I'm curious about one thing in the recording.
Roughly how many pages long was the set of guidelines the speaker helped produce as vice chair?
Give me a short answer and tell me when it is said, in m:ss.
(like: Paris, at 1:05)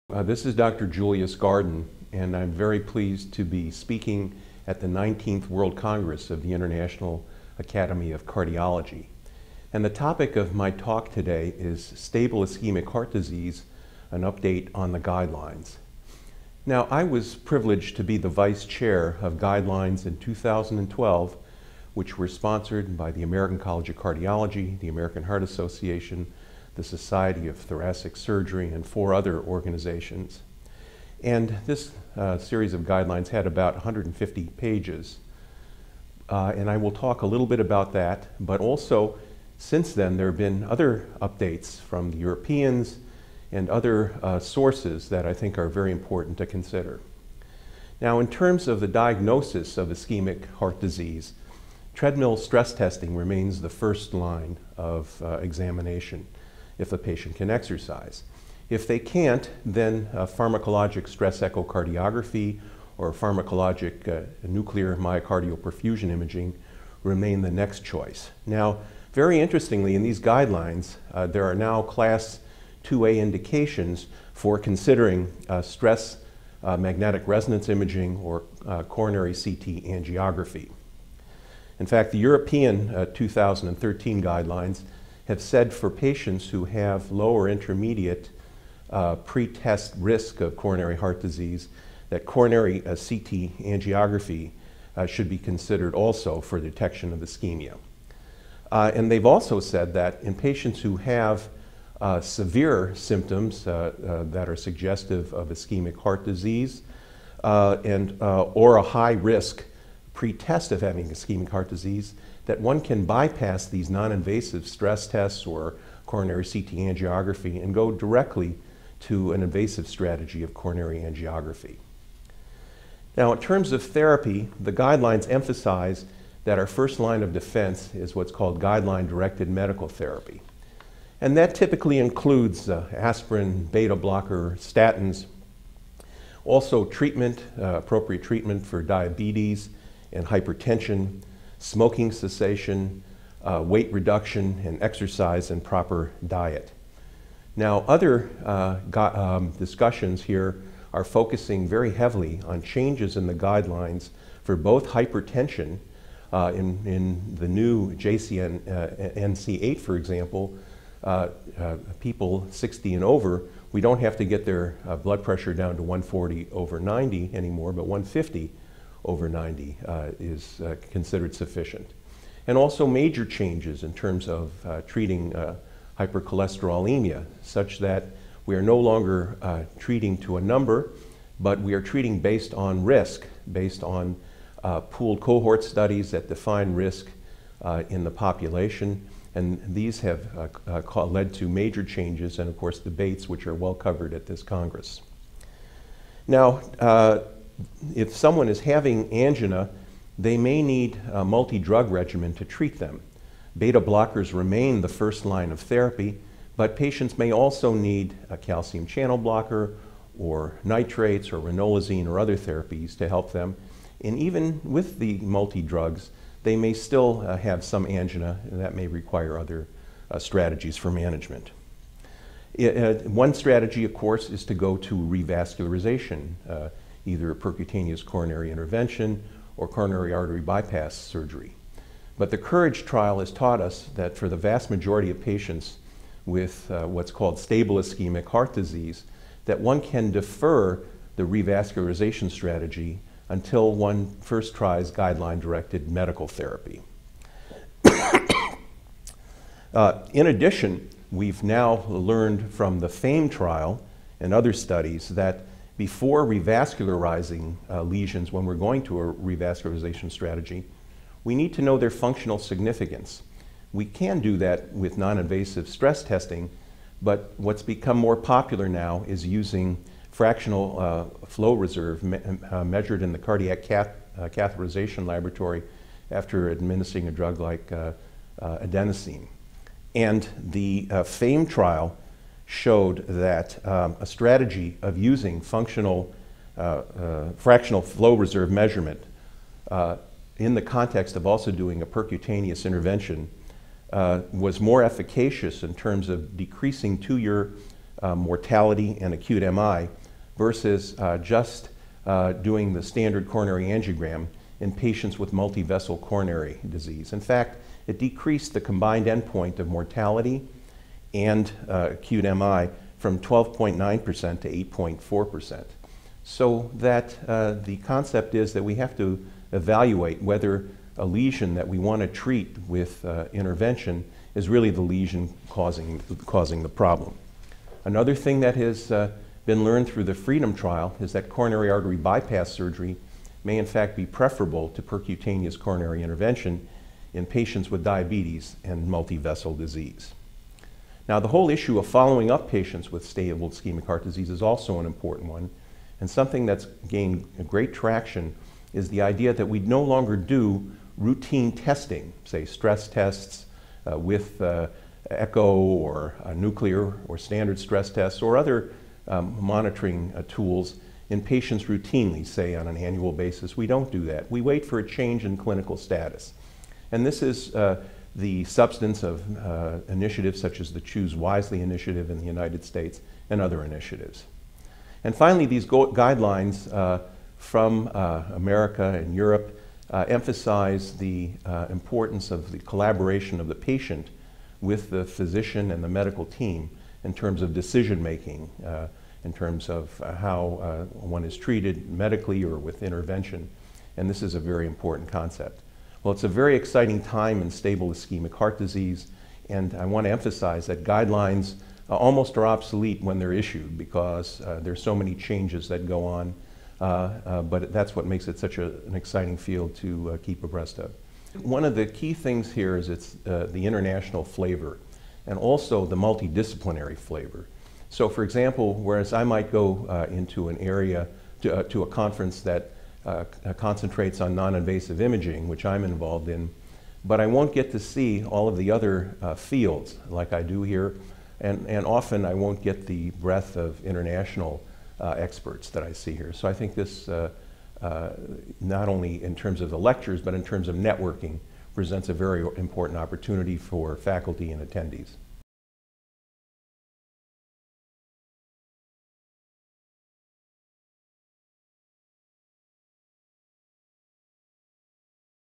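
150 pages, at 0:33.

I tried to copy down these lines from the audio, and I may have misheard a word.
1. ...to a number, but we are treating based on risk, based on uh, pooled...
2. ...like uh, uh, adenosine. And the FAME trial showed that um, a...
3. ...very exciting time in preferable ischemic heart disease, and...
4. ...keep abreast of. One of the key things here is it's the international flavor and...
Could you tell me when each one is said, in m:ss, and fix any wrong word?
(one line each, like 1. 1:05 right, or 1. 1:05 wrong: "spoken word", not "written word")
1. 3:00 right
2. 4:37 right
3. 6:36 wrong: "stable", not "preferable"
4. 6:50 right.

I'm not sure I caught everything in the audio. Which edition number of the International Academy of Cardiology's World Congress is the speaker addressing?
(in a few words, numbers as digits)
19th.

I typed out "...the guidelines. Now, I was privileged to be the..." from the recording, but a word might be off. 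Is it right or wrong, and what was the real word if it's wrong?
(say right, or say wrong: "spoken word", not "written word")
right.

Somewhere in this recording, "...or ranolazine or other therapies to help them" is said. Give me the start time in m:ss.
3:31.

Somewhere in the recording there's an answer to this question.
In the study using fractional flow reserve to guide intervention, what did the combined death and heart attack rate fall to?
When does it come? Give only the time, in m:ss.
5:14.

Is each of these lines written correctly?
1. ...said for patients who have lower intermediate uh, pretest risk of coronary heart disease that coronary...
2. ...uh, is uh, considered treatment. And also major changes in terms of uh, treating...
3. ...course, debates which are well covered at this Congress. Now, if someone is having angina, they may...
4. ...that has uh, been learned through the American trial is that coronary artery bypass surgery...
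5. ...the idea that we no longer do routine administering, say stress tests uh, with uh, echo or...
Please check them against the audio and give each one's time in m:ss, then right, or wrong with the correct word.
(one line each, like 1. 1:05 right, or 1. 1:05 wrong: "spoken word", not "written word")
1. 1:25 right
2. 2:49 wrong: "sufficient", not "treatment"
3. 3:12 right
4. 5:28 wrong: "FREEDOM", not "American"
5. 5:48 wrong: "testing", not "administering".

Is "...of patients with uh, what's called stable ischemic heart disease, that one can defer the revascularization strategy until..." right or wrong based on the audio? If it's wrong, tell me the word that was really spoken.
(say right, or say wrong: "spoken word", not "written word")
right.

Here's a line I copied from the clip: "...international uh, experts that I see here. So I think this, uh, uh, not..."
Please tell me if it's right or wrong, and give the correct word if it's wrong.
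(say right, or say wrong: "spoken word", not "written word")
right.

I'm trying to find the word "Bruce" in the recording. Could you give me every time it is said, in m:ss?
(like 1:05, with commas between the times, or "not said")
not said.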